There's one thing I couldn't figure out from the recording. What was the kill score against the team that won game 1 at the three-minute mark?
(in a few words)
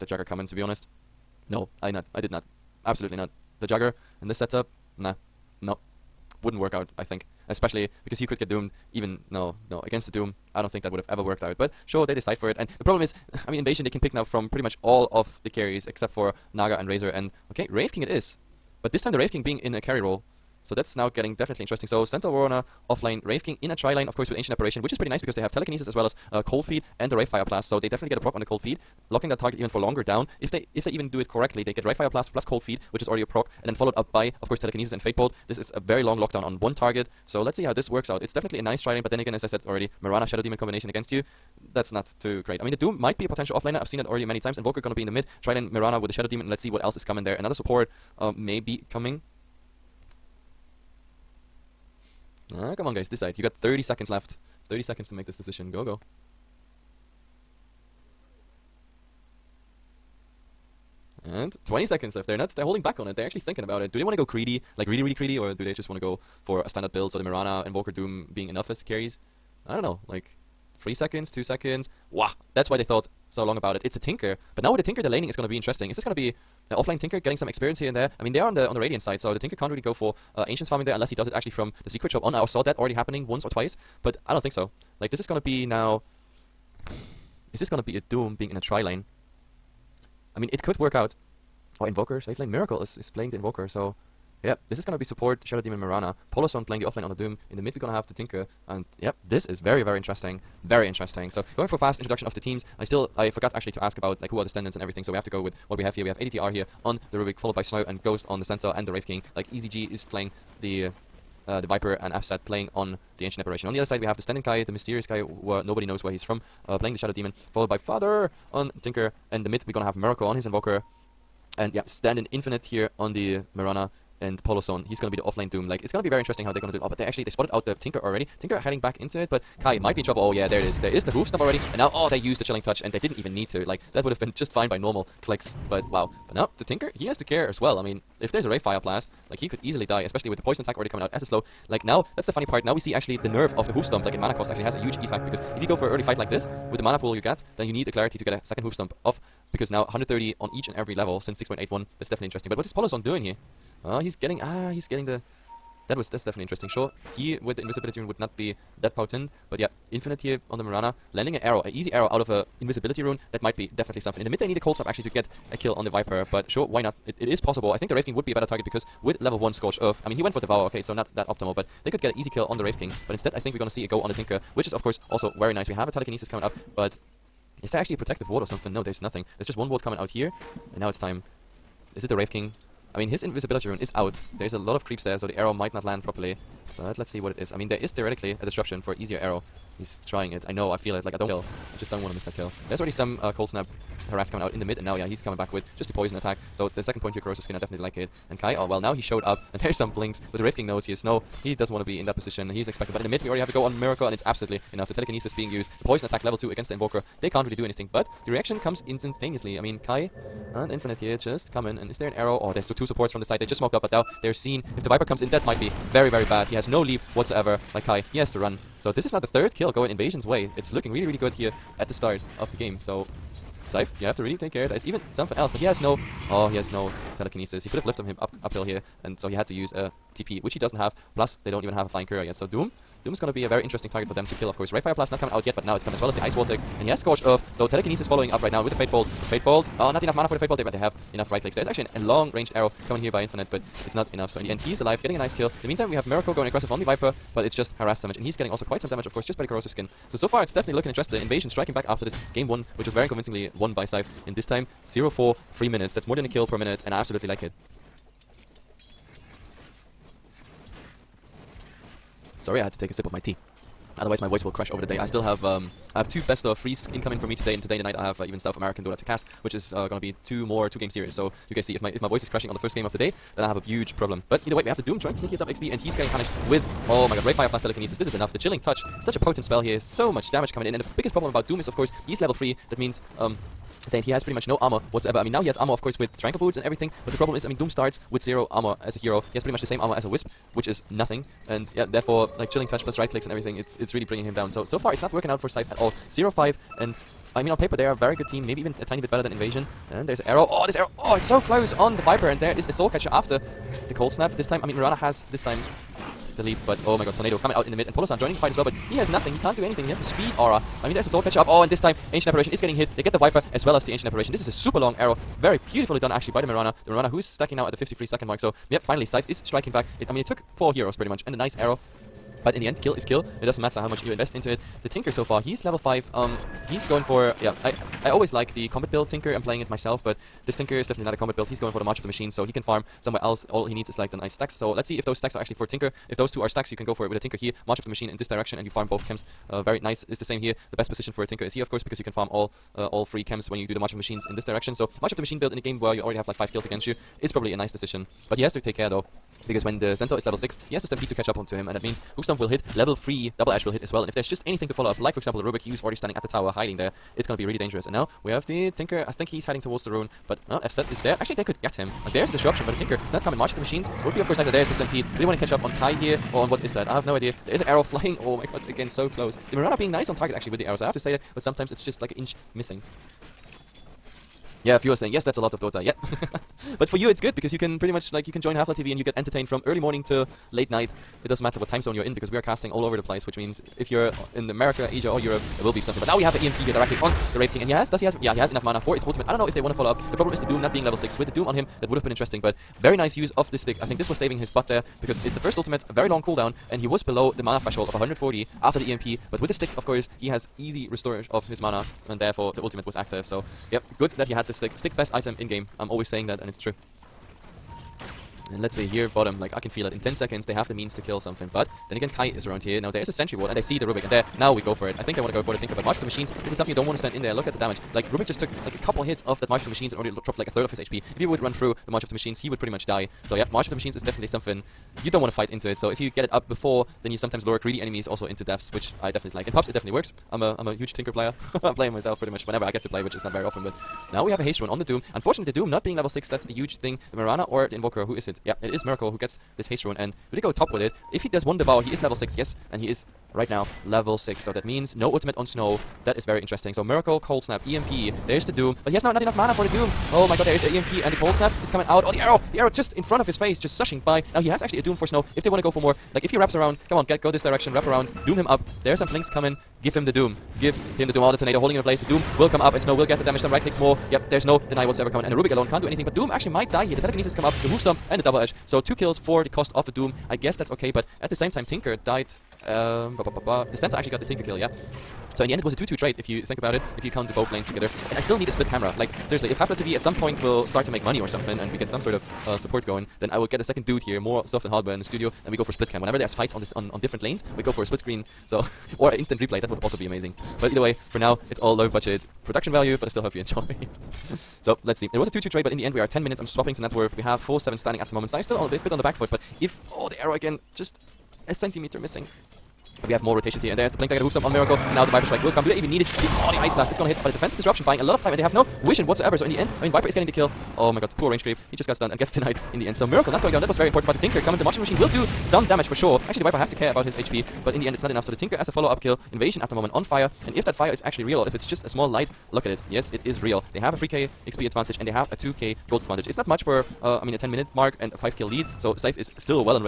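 0-4.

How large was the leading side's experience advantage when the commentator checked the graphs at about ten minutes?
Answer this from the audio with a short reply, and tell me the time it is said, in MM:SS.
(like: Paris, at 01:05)
3k, at 08:43.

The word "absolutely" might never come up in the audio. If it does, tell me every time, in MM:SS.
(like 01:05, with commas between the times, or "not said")
00:02, 03:24, 04:17.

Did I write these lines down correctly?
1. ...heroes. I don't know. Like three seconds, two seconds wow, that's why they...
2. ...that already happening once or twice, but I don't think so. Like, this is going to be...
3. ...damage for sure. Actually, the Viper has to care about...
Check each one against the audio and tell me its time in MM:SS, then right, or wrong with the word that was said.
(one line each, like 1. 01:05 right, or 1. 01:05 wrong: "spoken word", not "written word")
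1. 01:08 wrong: "carries", not "heroes"
2. 01:22 right
3. 08:35 right.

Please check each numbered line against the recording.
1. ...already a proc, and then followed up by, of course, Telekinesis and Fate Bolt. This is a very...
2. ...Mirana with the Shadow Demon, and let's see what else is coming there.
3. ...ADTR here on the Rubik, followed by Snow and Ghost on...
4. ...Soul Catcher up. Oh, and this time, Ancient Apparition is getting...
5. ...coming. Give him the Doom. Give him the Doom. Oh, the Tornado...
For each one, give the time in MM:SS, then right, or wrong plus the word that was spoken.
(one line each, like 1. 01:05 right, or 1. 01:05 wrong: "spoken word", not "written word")
1. 00:33 right
2. 00:45 right
3. 01:46 right
4. 05:11 right
5. 07:39 right.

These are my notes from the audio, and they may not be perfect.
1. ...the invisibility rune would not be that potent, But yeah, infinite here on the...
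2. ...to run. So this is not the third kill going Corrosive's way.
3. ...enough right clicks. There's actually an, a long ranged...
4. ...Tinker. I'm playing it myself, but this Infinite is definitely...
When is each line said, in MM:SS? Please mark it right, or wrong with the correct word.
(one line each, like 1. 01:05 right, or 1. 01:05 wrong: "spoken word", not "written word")
1. 02:37 right
2. 03:38 wrong: "Invasion", not "Corrosive"
3. 04:01 right
4. 05:29 wrong: "Tinker", not "Infinite".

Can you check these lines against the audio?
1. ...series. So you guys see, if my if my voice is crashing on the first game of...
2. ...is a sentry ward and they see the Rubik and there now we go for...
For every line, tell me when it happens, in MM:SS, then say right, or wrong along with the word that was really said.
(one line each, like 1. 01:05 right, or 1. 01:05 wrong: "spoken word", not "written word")
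1. 04:30 right
2. 06:53 right.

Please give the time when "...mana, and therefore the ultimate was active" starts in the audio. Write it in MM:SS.
06:41.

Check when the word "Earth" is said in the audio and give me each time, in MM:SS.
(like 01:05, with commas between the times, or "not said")
02:49, 03:57.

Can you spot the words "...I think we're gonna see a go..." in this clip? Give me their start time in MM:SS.
02:53.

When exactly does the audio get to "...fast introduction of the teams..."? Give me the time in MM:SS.
01:41.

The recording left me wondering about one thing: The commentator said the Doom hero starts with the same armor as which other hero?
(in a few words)
Wisp.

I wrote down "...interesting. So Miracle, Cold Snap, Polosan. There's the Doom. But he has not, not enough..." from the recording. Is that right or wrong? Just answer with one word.
wrong.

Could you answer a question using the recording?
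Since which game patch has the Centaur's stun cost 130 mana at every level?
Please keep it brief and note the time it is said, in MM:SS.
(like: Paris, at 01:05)
6.81, at 02:31.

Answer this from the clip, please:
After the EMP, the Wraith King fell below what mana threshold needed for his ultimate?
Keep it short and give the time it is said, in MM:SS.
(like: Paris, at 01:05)
140, at 06:37.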